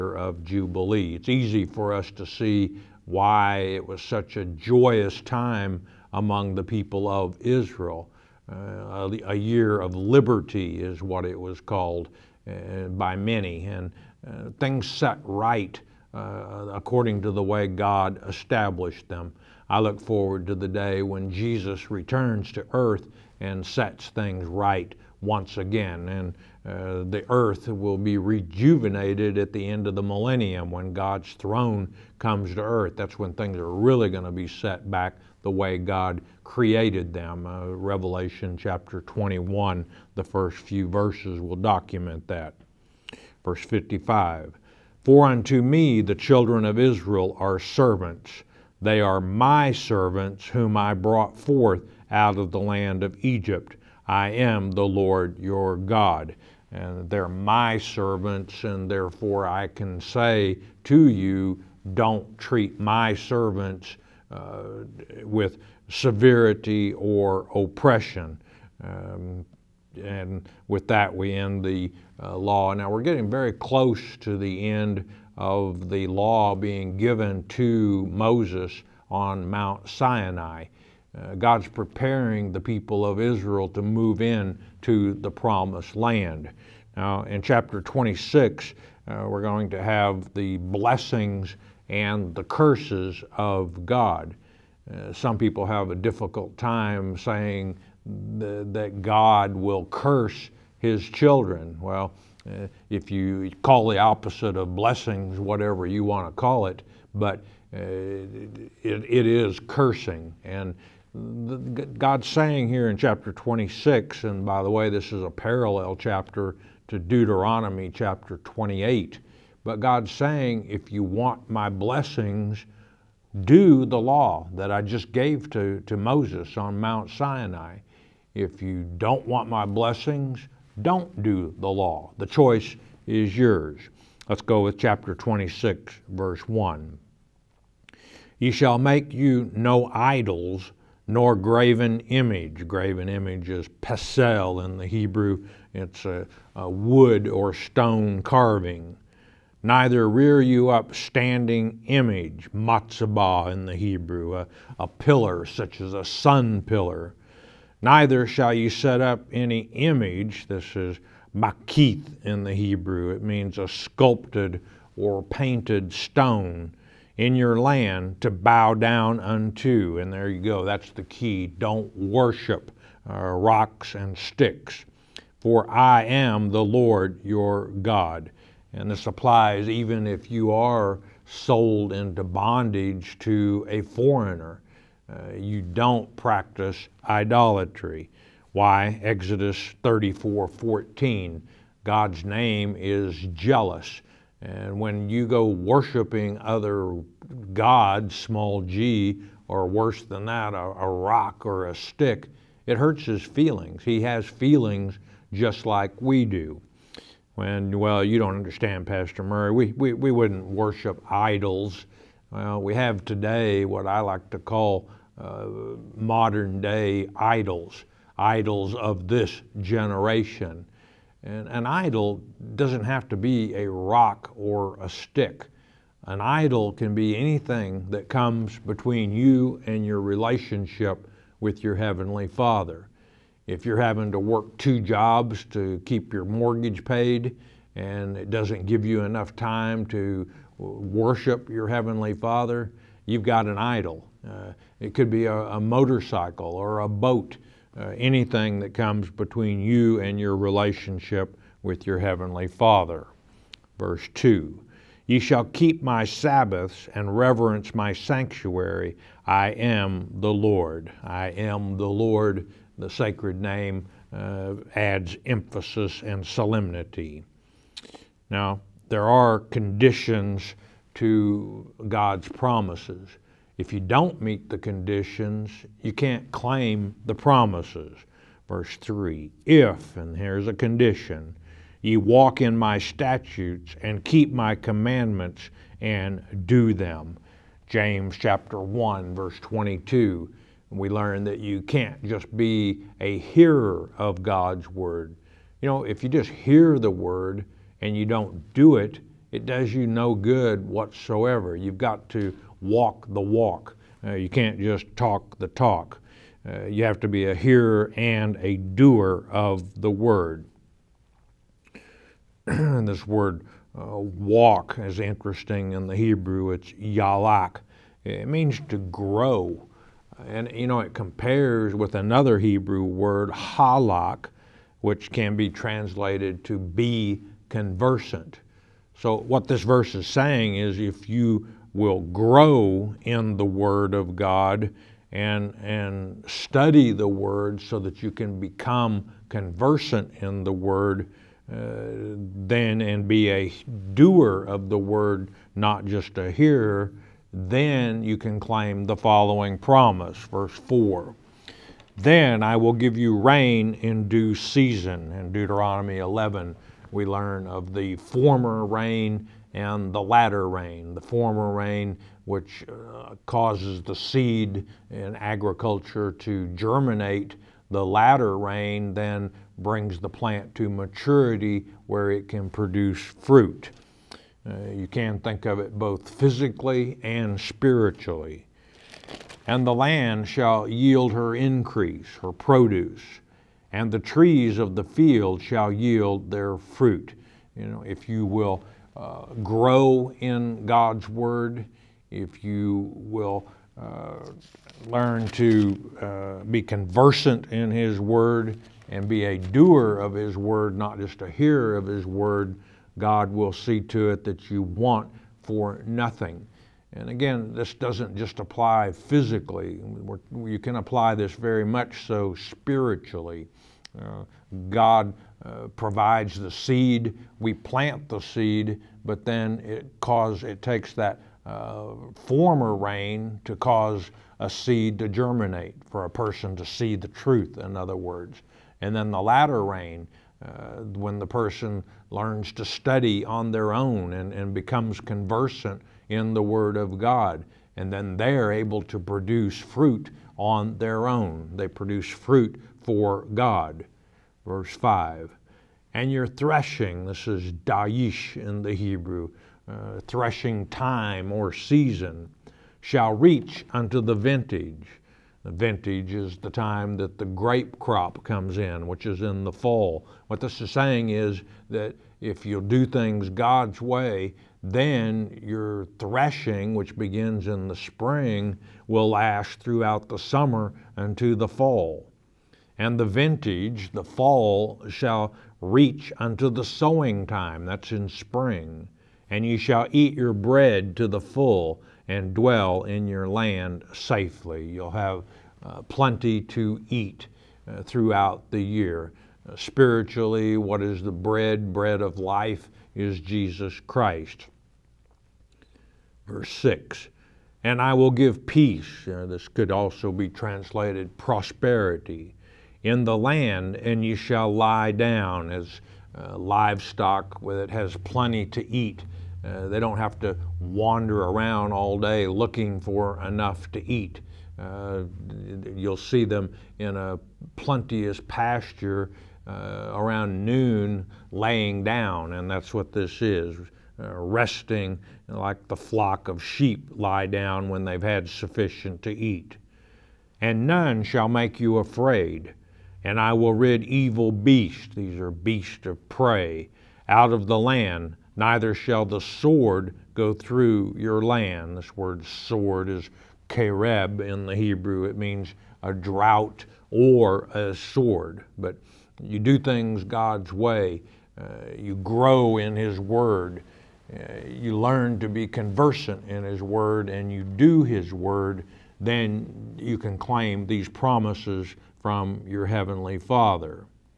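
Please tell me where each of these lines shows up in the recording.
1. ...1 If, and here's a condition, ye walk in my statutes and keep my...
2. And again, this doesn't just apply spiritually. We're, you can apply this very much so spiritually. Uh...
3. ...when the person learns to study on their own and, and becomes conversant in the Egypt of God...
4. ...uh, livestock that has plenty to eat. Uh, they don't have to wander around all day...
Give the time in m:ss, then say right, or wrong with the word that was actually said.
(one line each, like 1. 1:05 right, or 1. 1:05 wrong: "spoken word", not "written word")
1. 4:38 wrong: "3", not "1"
2. 6:46 wrong: "physically", not "spiritually"
3. 7:10 wrong: "Word", not "Egypt"
4. 8:26 right.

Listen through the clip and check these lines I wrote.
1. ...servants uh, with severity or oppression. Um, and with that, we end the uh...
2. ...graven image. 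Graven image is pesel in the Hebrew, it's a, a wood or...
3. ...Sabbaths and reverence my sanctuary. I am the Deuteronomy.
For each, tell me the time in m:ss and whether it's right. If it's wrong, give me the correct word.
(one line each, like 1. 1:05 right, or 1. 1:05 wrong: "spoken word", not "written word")
1. 1:03 right
2. 2:21 right
3. 4:16 wrong: "Lord", not "Deuteronomy".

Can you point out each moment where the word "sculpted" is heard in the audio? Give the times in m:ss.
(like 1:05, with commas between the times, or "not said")
2:43.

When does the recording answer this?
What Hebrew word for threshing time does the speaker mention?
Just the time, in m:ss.
7:27.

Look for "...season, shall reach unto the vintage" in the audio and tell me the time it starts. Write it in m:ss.
7:31.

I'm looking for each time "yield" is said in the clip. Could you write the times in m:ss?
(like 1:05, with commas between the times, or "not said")
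6:20, 6:25.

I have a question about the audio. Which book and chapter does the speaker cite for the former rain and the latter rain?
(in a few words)
Deuteronomy 11.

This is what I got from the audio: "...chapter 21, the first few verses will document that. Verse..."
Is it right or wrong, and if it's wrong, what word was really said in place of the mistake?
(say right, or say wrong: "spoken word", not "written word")
right.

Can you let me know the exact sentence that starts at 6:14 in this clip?
Uh, you can think of it both physically and spiritually.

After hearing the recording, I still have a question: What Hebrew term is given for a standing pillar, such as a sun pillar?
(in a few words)
matzabah.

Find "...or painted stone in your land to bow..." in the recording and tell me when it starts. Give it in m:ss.
2:44.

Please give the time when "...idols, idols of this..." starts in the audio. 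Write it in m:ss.
3:37.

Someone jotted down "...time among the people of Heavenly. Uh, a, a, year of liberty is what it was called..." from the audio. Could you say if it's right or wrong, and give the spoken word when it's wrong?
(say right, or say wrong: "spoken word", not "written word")
wrong: "Israel", not "Heavenly".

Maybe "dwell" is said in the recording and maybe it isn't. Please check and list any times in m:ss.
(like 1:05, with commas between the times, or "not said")
8:02.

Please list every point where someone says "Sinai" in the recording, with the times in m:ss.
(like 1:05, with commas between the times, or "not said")
1:19, 2:07.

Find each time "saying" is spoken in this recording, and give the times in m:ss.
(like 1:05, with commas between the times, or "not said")
1:37, 1:52, 2:00, 5:30, 7:40.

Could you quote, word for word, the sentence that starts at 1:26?
Now, in chapter 26, uh, we're going to have the blessings and the curses of God.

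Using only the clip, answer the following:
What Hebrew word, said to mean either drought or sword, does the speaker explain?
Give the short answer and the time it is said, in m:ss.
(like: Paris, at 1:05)
kereb, at 9:03.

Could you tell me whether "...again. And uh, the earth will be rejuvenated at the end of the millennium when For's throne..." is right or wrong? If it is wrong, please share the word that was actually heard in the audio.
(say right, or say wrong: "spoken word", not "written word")
wrong: "God", not "For".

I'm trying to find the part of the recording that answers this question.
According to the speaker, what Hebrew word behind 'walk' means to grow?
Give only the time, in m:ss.
5:16.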